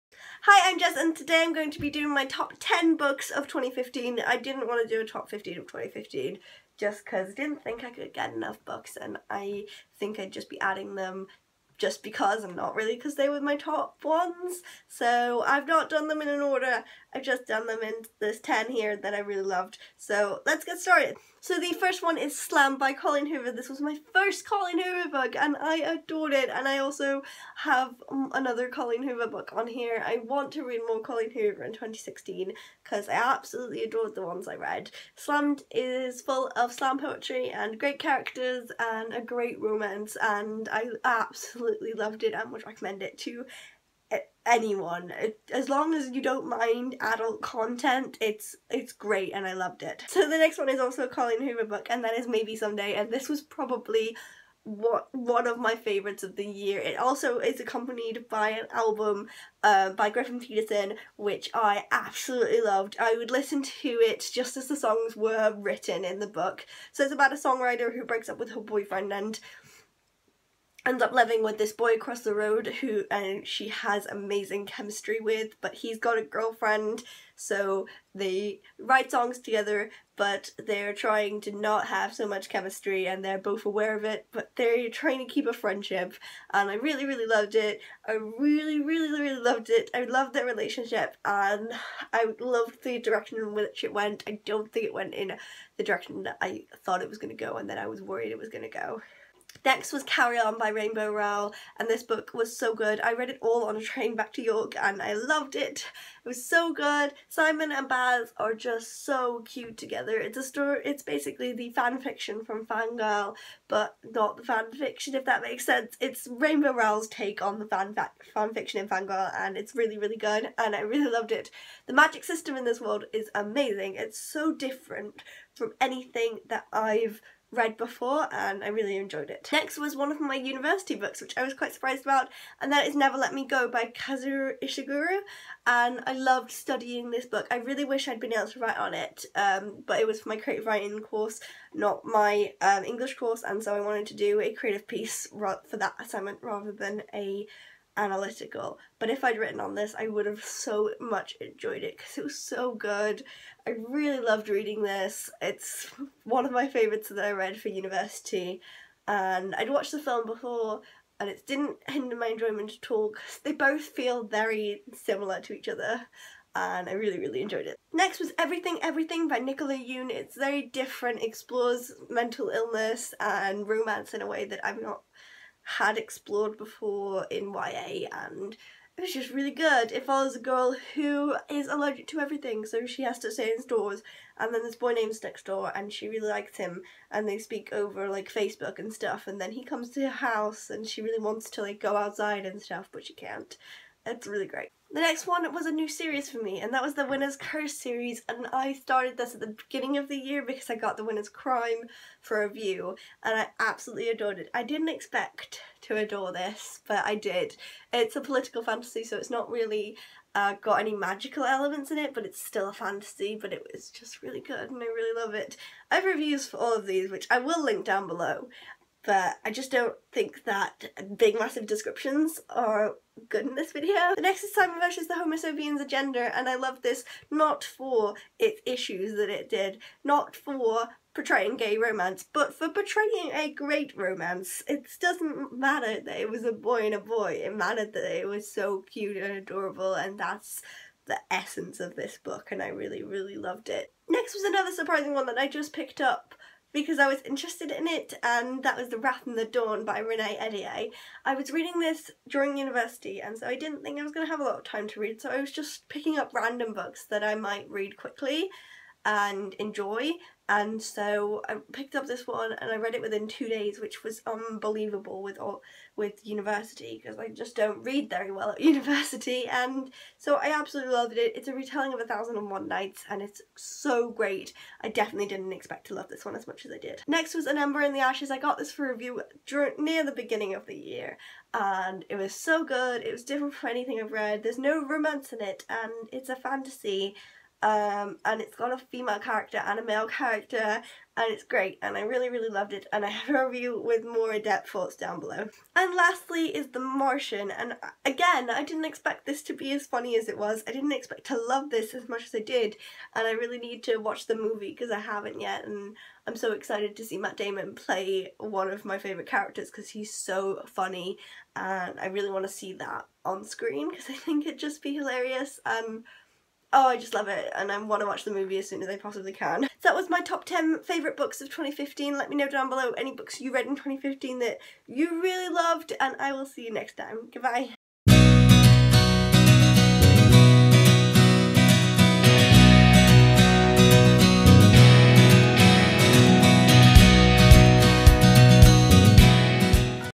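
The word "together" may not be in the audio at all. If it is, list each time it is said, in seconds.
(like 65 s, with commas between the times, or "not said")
79 s, 109 s.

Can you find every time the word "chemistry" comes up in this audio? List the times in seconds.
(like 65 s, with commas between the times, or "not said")
74 s, 82 s.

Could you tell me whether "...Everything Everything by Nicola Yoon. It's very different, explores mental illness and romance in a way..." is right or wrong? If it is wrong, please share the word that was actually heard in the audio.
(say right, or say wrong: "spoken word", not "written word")
right.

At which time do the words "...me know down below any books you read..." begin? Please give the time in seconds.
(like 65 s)
322 s.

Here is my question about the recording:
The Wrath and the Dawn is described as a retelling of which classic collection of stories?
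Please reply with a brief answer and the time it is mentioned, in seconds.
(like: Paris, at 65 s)
A Thousand and One Nights, at 272 s.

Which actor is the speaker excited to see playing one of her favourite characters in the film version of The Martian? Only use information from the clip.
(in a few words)
Matt Damon.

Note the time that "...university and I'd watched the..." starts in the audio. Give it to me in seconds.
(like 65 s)
157 s.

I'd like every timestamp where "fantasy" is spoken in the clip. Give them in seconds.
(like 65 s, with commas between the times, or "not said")
208 s, 212 s, 286 s.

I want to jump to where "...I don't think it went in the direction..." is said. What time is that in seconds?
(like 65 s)
94 s.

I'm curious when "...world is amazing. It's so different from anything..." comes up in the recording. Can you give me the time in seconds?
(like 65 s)
122 s.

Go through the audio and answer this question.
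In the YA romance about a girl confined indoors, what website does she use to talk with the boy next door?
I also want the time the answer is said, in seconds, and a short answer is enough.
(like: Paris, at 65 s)
Facebook, at 188 s.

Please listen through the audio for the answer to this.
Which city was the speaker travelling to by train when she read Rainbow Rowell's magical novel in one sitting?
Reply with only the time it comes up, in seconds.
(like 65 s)
104 s.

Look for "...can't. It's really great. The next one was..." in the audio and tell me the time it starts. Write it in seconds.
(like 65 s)
193 s.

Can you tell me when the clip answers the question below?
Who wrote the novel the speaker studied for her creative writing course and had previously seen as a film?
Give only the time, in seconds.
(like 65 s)
133 s.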